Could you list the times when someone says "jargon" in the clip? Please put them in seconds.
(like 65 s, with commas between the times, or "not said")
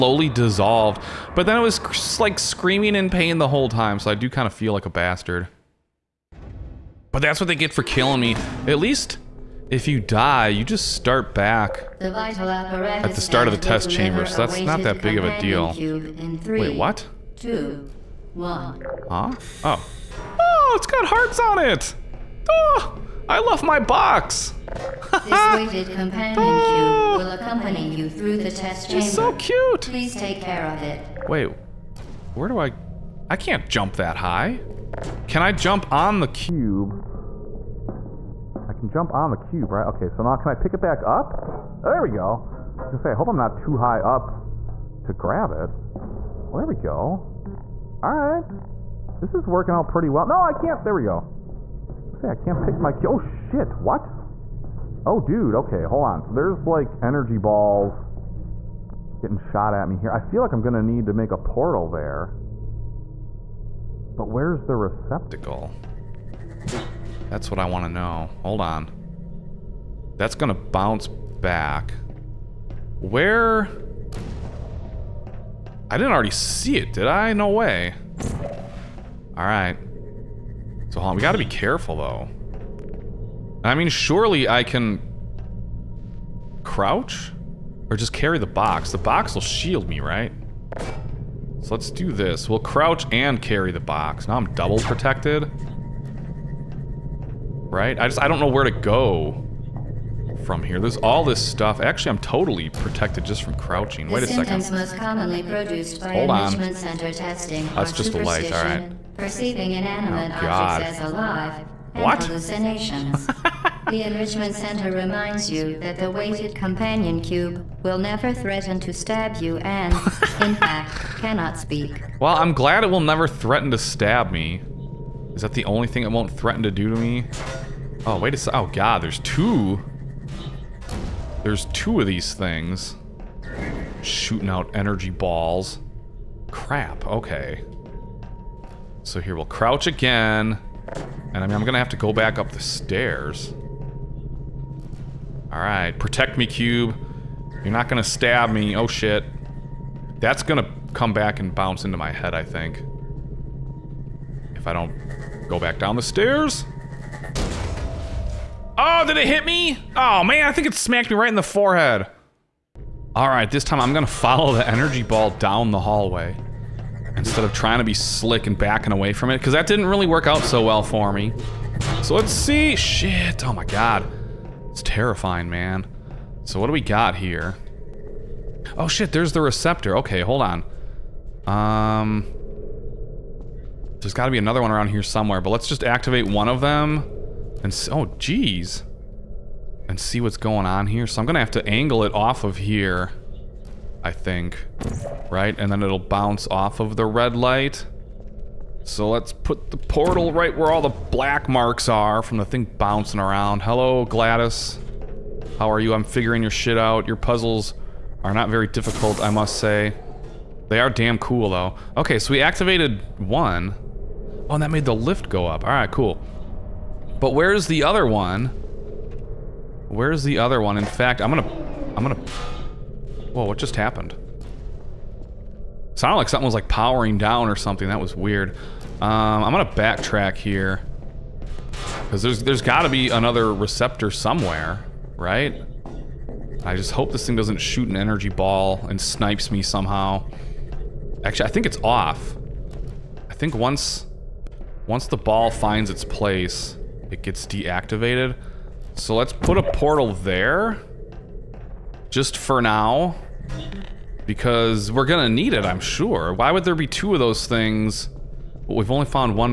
not said.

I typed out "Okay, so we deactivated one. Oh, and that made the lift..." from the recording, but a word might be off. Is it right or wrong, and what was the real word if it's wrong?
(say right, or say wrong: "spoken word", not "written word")
wrong: "activated", not "deactivated".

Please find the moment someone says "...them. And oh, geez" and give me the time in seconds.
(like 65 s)
186 s.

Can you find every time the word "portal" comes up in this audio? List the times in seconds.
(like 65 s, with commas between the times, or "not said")
61 s, 199 s, 249 s.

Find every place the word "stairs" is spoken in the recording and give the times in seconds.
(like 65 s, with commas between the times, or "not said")
142 s, 156 s.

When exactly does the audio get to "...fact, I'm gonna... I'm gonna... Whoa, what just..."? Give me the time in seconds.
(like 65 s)
220 s.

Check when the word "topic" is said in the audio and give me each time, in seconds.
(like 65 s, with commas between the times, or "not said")
not said.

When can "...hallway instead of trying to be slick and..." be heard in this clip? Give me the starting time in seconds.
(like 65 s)
165 s.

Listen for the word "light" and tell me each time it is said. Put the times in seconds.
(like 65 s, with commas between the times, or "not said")
108 s, 197 s.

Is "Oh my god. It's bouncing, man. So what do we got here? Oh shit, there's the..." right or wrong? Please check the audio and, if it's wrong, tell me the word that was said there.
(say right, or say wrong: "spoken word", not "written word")
wrong: "terrifying", not "bouncing".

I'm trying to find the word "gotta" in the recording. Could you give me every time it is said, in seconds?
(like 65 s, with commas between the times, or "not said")
81 s, 232 s.